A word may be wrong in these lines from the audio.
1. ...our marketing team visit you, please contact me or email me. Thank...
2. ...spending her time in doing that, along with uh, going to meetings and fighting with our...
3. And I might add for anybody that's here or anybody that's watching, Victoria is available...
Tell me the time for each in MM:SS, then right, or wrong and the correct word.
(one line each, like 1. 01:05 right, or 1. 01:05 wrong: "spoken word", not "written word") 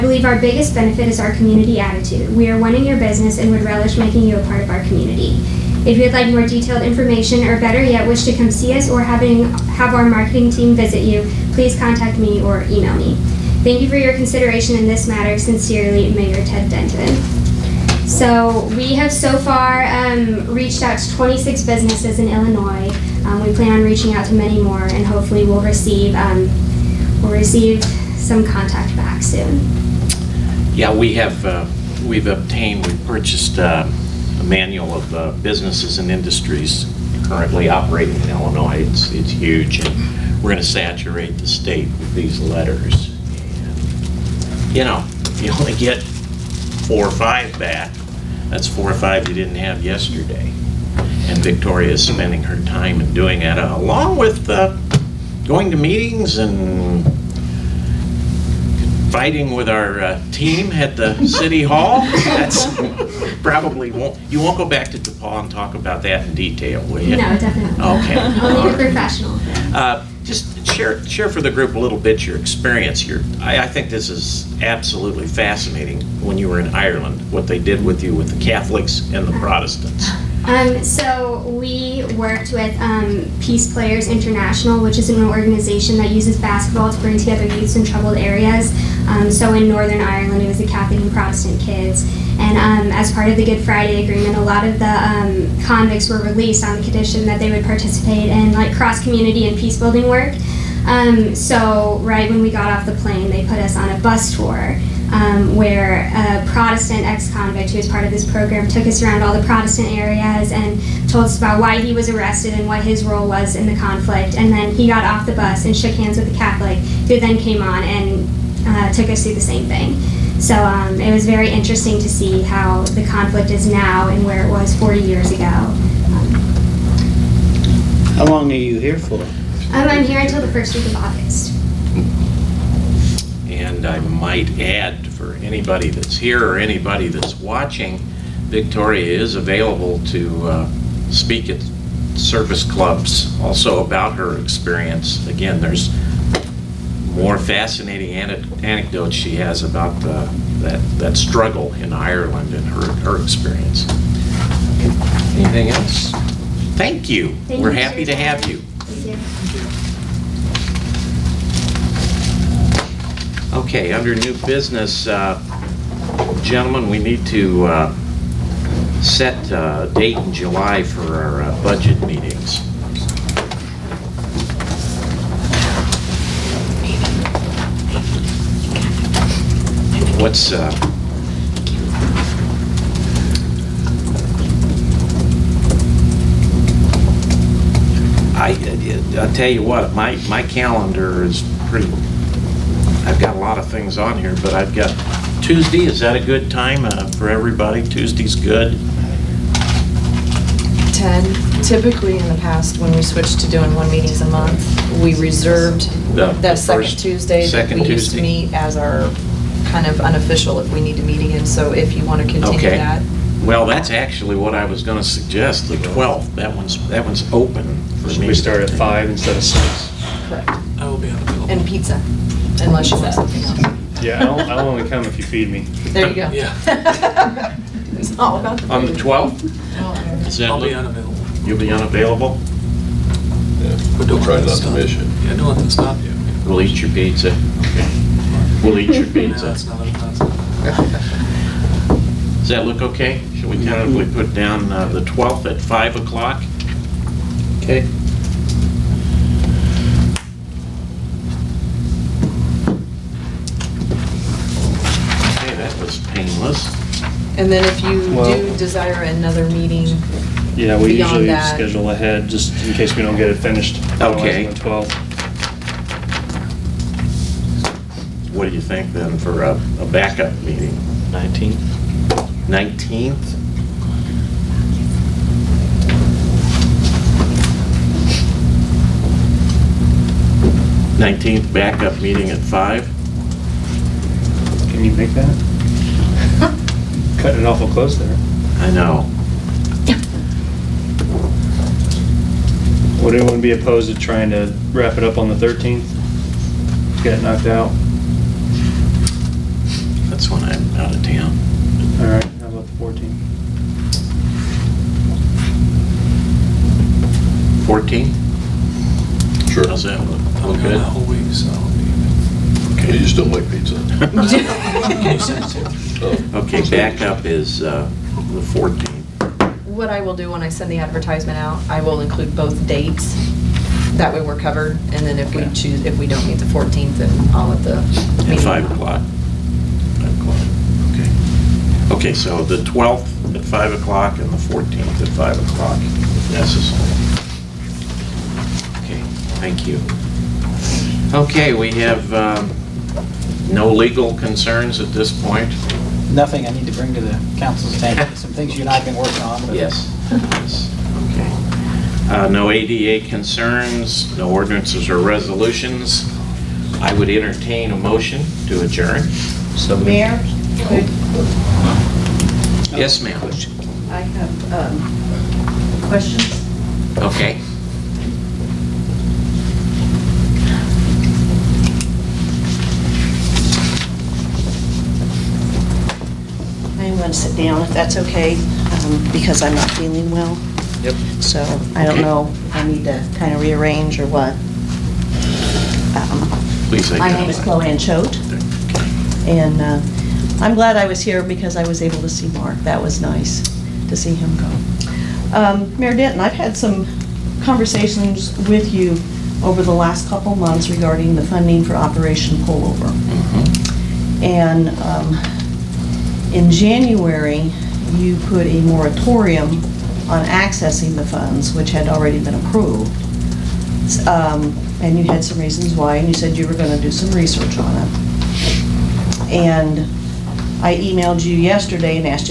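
1. 00:09 right
2. 00:52 right
3. 02:13 right.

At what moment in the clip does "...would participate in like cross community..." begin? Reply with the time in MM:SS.
01:37.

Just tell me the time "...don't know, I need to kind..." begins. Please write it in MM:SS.
06:21.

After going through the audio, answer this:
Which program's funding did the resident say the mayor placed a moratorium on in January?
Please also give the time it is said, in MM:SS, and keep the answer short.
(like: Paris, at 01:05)
Operation Pullover, at 06:41.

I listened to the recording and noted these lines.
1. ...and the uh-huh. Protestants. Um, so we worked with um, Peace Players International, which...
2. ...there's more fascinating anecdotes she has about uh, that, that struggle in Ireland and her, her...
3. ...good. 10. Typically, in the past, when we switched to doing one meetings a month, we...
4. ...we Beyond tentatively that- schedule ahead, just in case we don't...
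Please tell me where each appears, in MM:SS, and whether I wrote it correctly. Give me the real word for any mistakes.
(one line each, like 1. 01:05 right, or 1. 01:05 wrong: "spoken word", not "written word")
1. 01:19 right
2. 02:25 right
3. 03:18 right
4. 04:20 wrong: "usually", not "tentatively".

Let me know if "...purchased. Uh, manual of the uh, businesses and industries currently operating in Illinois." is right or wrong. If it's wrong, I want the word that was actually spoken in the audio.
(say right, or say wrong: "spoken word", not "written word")
right.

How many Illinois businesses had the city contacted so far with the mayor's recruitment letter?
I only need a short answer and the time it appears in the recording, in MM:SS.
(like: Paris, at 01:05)
26, at 00:21.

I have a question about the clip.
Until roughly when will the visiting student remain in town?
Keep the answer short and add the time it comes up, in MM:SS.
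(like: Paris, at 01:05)
First week of August, at 02:10.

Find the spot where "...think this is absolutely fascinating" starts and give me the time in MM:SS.
01:13.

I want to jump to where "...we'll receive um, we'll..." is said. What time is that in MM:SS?
00:25.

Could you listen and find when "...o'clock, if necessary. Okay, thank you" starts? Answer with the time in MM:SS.
05:35.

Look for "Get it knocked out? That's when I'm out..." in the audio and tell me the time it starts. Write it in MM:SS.
04:57.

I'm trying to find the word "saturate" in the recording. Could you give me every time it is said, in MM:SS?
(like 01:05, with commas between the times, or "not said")
00:40.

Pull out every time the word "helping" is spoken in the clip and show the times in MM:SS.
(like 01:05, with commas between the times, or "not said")
not said.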